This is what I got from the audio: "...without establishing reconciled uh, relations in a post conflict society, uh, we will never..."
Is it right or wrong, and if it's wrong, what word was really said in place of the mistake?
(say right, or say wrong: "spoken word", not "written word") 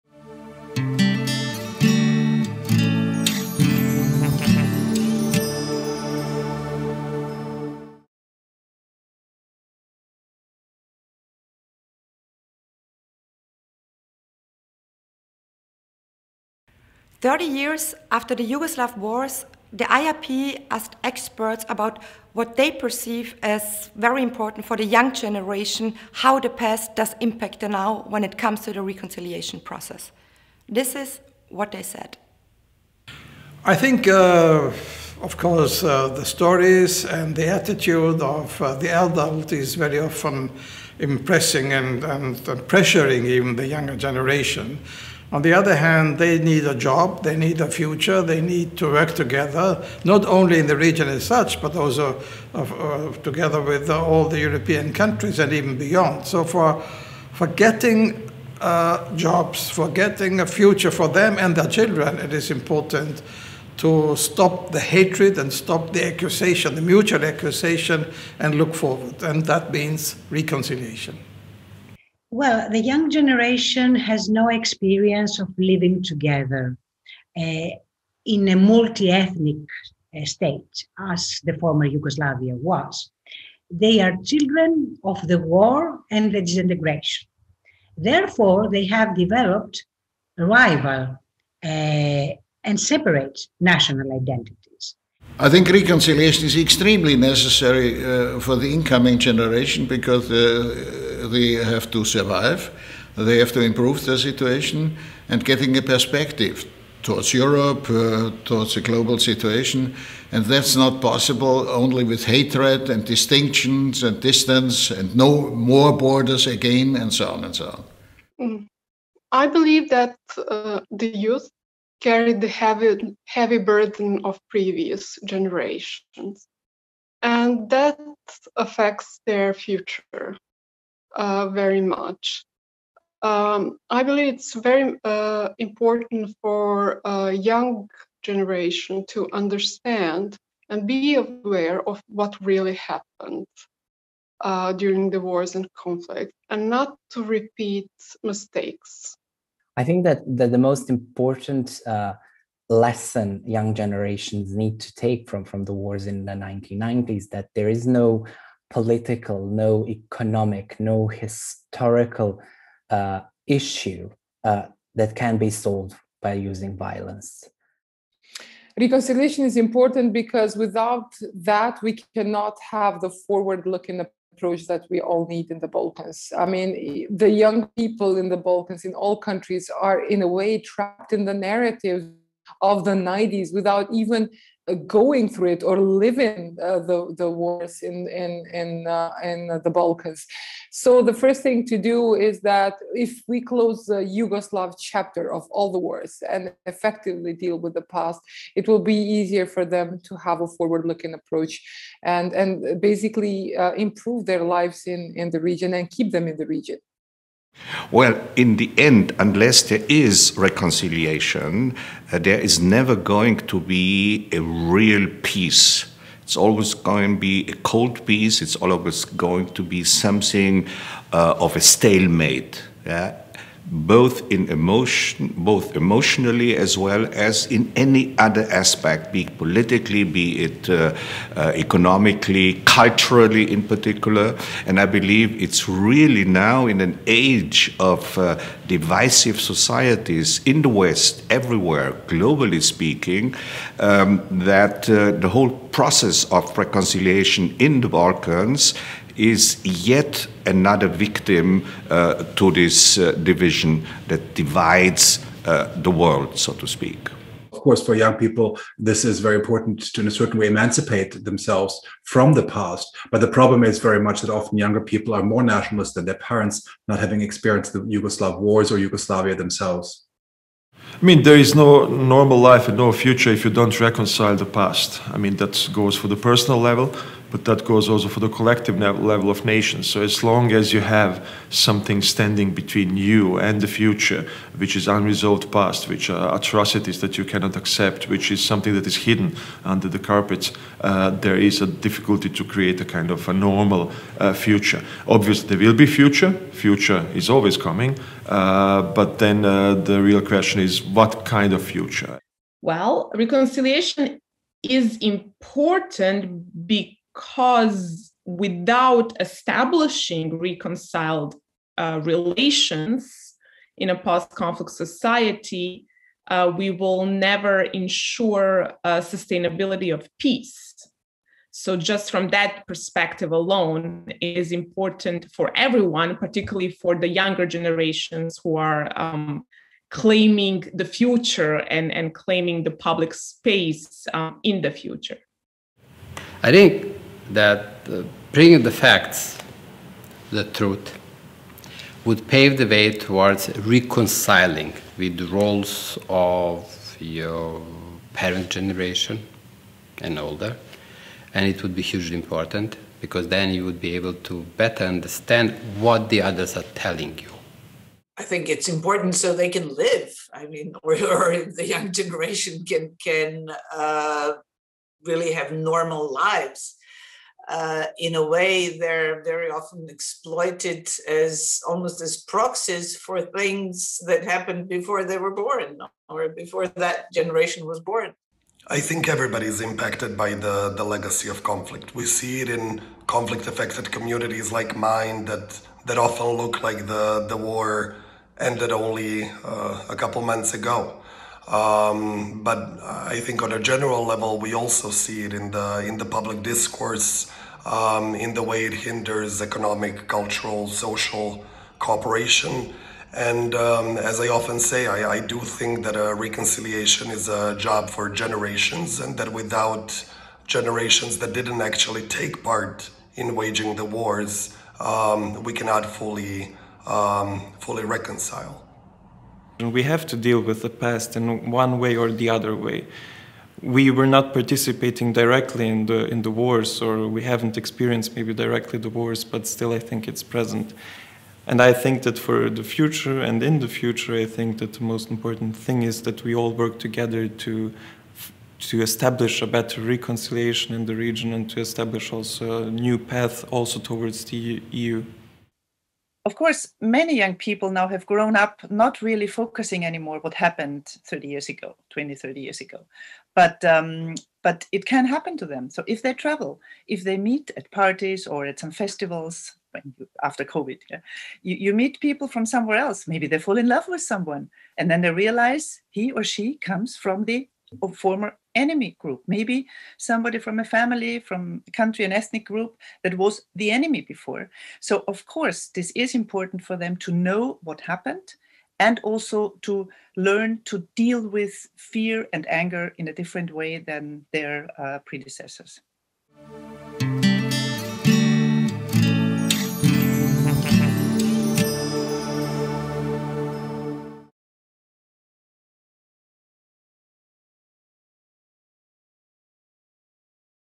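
right.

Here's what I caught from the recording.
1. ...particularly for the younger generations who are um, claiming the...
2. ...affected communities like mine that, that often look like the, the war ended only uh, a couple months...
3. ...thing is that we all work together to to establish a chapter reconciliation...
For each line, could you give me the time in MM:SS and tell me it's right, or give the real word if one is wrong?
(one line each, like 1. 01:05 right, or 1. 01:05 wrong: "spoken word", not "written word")
1. 05:26 right
2. 06:23 right
3. 07:15 wrong: "better", not "chapter".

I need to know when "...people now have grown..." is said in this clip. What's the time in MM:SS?
07:27.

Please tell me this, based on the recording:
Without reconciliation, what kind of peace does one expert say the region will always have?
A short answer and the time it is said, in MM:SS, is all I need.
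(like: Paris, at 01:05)
cold peace, at 03:37.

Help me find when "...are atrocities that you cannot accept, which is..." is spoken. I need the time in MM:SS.
04:46.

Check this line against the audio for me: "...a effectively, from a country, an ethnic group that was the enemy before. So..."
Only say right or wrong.
wrong.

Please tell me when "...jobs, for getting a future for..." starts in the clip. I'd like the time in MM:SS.
00:59.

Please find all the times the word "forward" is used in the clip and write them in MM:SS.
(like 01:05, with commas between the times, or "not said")
01:08, 02:53, 03:20.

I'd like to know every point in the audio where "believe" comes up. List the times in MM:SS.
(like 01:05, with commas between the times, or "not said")
01:59, 02:14, 03:54.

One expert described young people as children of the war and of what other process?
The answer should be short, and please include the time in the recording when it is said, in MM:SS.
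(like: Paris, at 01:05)
disintegration, at 01:26.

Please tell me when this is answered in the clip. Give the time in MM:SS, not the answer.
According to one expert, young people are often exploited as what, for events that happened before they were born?
06:12.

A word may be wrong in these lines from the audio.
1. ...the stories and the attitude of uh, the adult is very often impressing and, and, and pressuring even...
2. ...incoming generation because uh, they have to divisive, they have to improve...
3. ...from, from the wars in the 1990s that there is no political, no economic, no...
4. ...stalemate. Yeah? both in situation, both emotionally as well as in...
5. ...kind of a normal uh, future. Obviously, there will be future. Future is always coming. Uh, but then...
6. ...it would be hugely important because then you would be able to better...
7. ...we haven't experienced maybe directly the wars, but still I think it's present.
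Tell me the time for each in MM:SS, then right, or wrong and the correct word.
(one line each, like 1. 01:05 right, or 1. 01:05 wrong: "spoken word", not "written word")
1. 00:36 right
2. 01:38 wrong: "survive", not "divisive"
3. 02:35 right
4. 03:41 wrong: "emotion", not "situation"
5. 04:52 right
6. 05:51 right
7. 07:07 right.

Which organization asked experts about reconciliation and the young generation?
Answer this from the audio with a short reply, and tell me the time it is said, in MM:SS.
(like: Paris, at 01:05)
IIP, at 00:19.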